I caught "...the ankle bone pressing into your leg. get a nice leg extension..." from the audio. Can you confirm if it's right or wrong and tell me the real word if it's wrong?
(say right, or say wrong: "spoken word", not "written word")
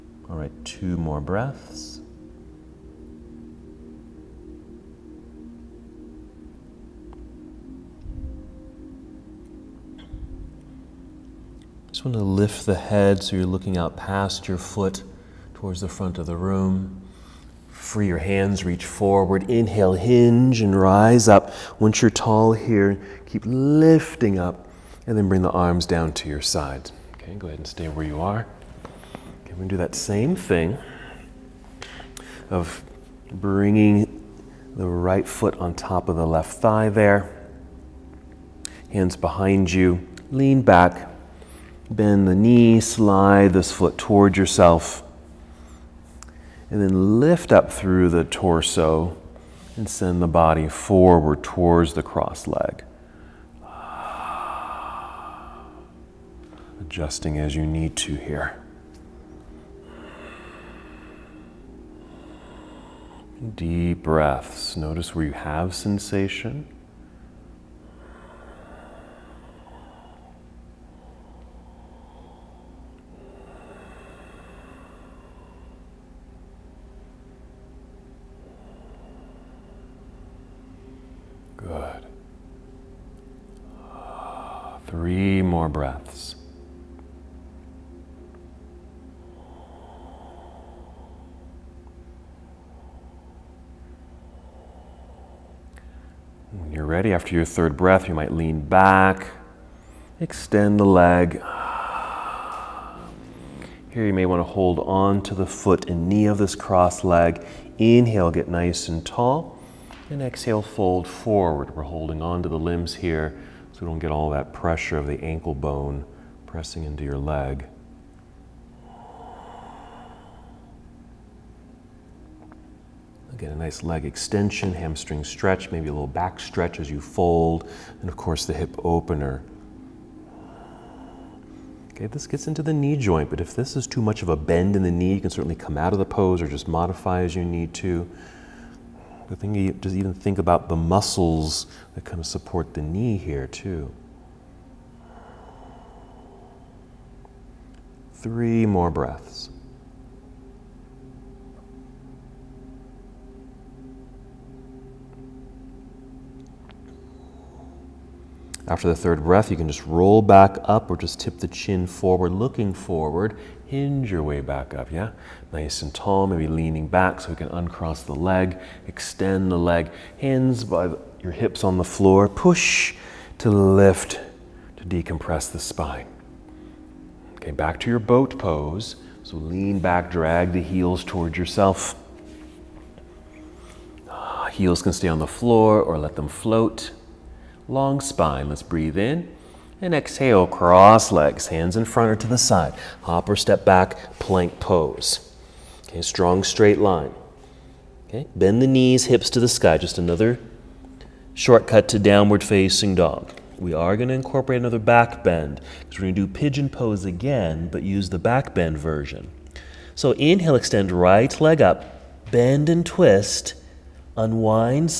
right.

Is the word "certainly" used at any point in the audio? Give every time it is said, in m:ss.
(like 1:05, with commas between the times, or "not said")
2:15.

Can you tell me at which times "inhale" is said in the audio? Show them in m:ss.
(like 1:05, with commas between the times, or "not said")
0:19, 1:47, 3:30.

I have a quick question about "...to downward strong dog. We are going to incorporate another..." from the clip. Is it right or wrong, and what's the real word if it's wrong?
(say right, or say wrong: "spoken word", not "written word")
wrong: "facing", not "strong".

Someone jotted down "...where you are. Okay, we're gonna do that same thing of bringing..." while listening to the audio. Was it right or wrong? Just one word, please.
right.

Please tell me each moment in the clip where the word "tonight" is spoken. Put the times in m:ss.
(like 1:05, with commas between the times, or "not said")
not said.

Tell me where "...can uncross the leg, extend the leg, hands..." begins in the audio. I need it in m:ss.
2:47.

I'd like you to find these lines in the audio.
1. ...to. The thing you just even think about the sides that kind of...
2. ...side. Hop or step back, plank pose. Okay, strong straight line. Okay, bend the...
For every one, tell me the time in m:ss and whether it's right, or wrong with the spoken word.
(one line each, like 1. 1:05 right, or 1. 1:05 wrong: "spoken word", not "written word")
1. 2:17 wrong: "muscles", not "sides"
2. 3:12 right.